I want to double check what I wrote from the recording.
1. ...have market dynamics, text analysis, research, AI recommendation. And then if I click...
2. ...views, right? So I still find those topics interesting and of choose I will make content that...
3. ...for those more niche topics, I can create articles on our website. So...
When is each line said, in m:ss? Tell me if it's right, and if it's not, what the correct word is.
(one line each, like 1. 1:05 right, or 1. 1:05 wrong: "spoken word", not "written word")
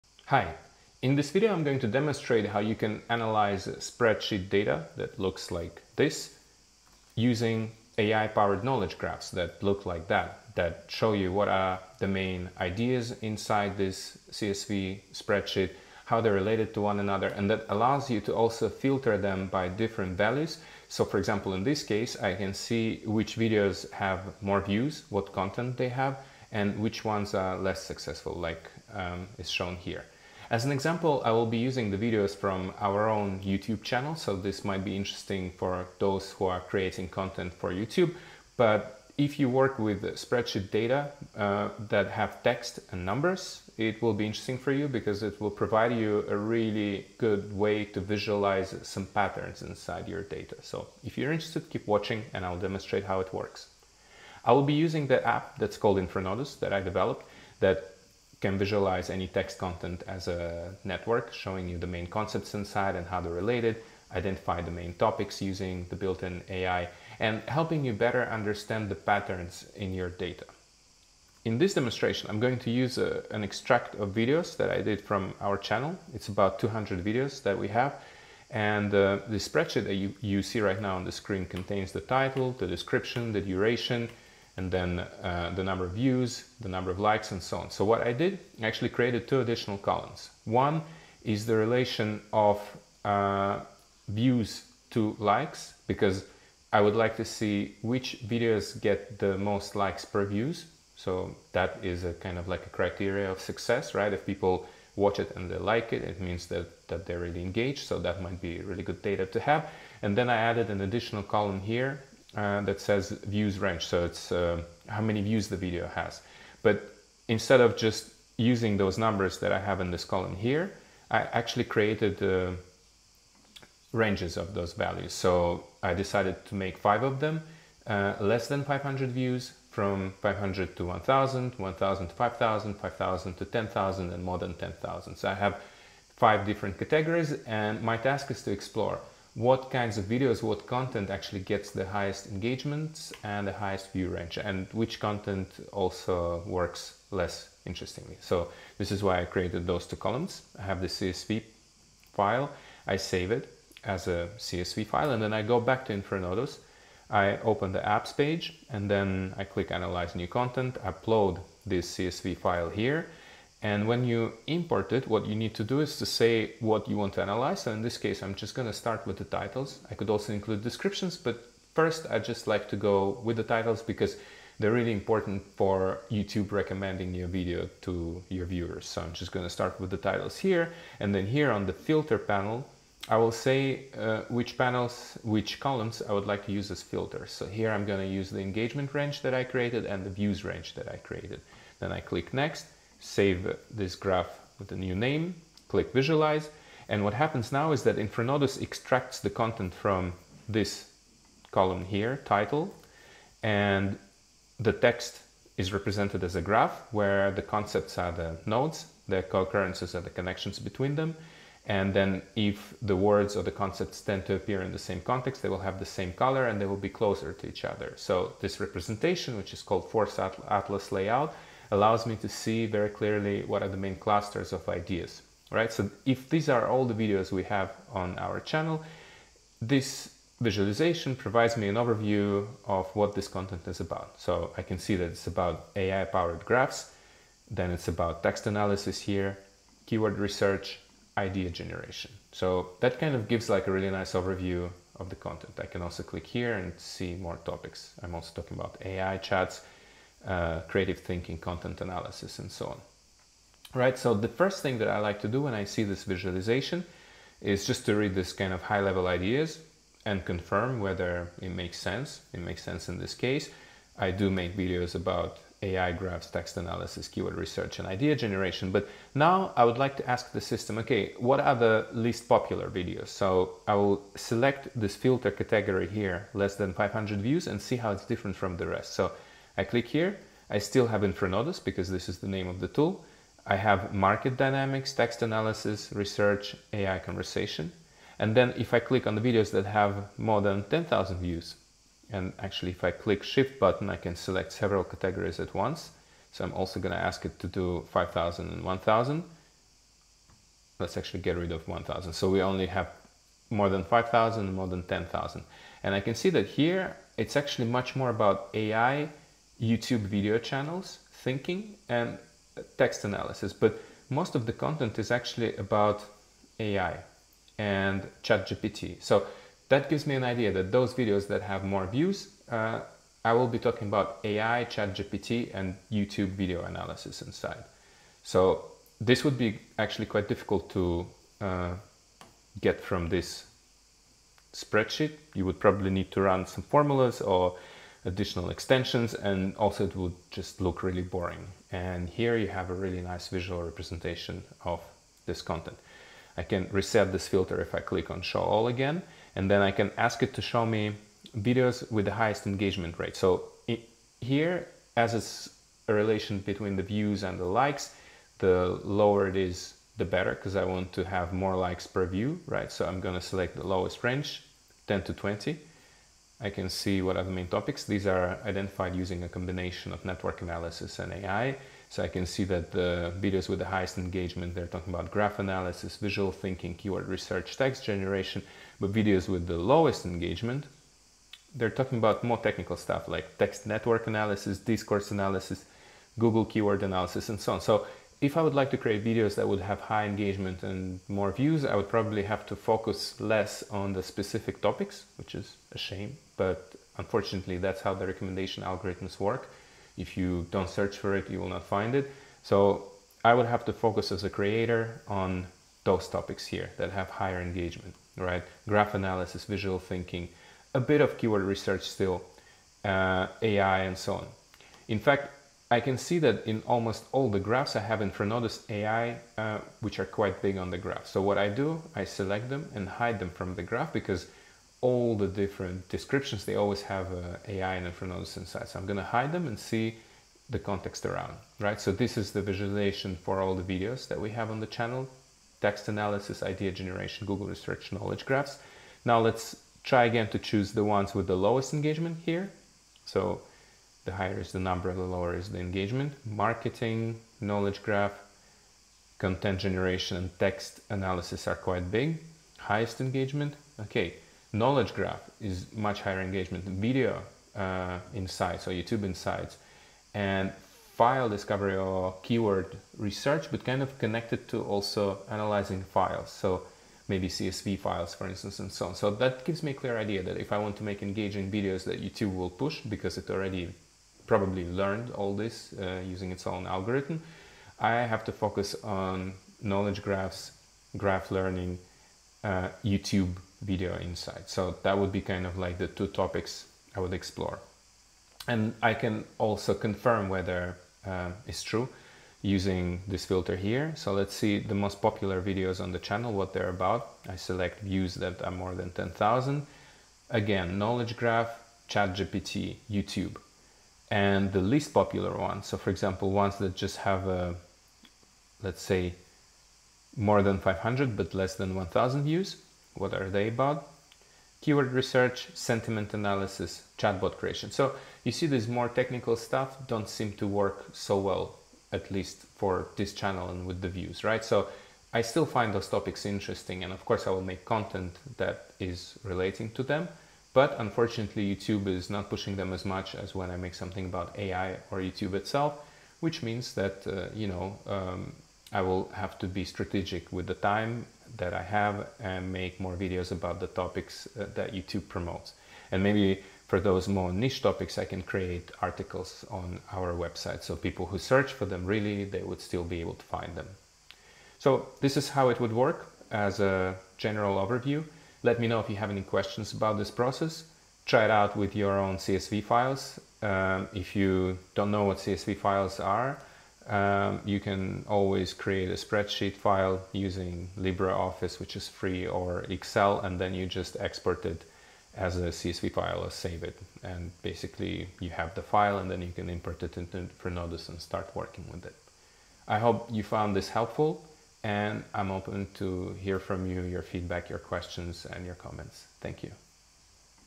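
1. 4:43 wrong: "conversation", not "recommendation"
2. 8:43 wrong: "course", not "choose"
3. 9:06 right.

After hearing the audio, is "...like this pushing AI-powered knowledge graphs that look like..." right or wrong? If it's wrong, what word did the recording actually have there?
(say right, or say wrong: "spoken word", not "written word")
wrong: "using", not "pushing".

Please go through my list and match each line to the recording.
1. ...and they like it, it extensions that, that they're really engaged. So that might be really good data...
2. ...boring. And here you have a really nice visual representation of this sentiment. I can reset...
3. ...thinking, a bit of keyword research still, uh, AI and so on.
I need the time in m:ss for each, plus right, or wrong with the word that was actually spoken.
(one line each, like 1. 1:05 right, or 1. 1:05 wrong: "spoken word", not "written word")
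1. 1:45 wrong: "means", not "extensions"
2. 5:41 wrong: "content", not "sentiment"
3. 6:49 right.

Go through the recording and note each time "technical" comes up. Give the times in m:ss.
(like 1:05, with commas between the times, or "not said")
6:22, 8:38.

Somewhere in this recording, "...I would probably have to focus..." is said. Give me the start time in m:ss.
6:31.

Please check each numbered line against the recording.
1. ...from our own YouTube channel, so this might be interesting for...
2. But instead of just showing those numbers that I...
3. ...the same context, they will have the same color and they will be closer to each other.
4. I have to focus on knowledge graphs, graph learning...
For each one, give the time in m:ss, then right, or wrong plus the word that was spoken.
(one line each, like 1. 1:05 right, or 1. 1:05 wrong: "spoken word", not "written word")
1. 0:32 right
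2. 1:56 wrong: "using", not "showing"
3. 3:34 right
4. 7:57 right.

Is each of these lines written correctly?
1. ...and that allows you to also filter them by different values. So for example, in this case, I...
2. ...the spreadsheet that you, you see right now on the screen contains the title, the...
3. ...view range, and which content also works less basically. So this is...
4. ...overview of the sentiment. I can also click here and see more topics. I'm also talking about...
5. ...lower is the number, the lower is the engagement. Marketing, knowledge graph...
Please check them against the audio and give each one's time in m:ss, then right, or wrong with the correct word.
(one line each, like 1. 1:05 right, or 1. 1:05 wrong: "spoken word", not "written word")
1. 0:17 right
2. 1:19 right
3. 2:23 wrong: "interestingly", not "basically"
4. 4:04 wrong: "content", not "sentiment"
5. 7:24 wrong: "higher", not "lower".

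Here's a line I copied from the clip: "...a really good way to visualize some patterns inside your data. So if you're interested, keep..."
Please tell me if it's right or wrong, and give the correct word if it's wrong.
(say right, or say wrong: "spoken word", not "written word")
right.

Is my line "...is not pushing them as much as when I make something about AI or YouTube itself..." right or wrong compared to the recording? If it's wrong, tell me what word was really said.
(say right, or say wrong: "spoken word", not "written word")
right.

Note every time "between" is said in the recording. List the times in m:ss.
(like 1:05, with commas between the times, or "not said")
3:30, 5:56.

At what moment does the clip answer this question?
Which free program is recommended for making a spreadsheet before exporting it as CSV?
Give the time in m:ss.
9:30.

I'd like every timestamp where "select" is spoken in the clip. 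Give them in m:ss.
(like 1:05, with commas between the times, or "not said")
4:34, 4:54, 6:03, 7:02, 8:17.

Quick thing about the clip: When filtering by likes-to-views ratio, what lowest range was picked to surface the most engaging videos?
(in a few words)
10 to 20.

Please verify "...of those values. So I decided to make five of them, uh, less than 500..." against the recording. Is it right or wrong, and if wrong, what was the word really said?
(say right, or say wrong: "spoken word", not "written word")
right.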